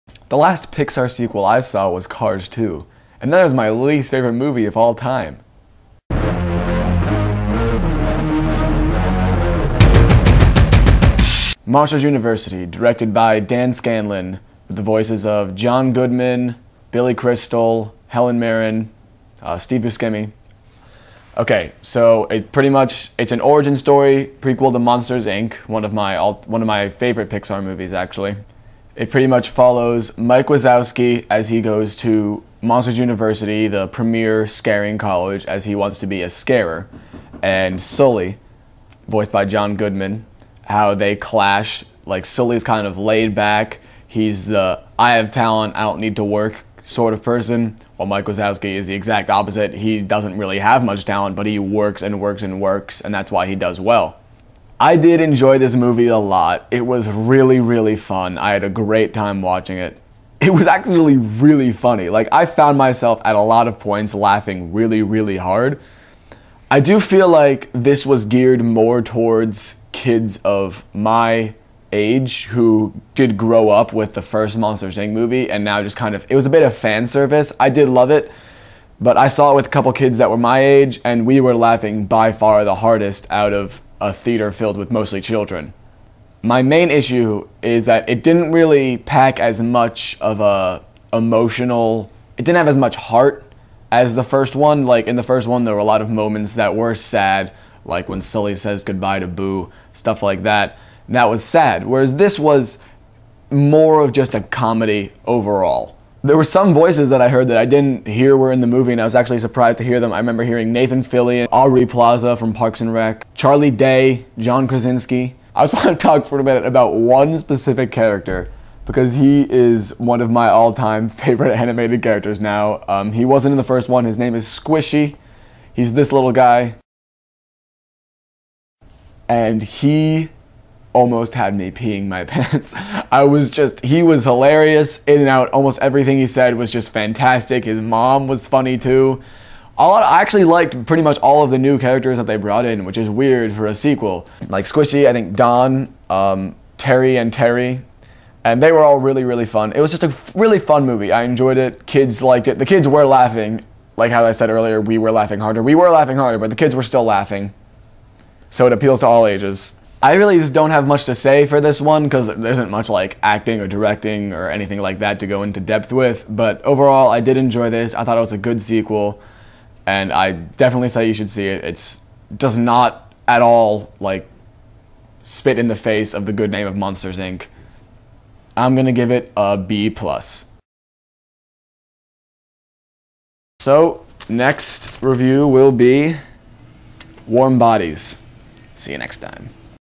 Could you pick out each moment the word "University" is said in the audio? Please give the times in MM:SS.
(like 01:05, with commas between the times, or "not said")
00:12, 00:32.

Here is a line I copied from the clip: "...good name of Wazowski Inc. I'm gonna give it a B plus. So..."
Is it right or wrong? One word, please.
wrong.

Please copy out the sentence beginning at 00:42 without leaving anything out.
Like Sully's kind of laid back.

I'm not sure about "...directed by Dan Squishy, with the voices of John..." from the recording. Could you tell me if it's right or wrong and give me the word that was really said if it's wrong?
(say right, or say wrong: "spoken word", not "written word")
wrong: "Scanlon", not "Squishy".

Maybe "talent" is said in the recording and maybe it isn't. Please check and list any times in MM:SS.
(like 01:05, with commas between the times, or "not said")
00:45, 00:51.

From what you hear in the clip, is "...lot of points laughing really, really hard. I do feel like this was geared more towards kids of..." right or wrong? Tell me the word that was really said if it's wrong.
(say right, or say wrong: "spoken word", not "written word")
right.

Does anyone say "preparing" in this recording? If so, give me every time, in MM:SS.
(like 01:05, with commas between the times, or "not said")
not said.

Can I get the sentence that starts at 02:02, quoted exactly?
Um, he wasn't in the first one.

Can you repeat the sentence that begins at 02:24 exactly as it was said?
Like Squishy, I think Don, um, Terry, and Terry.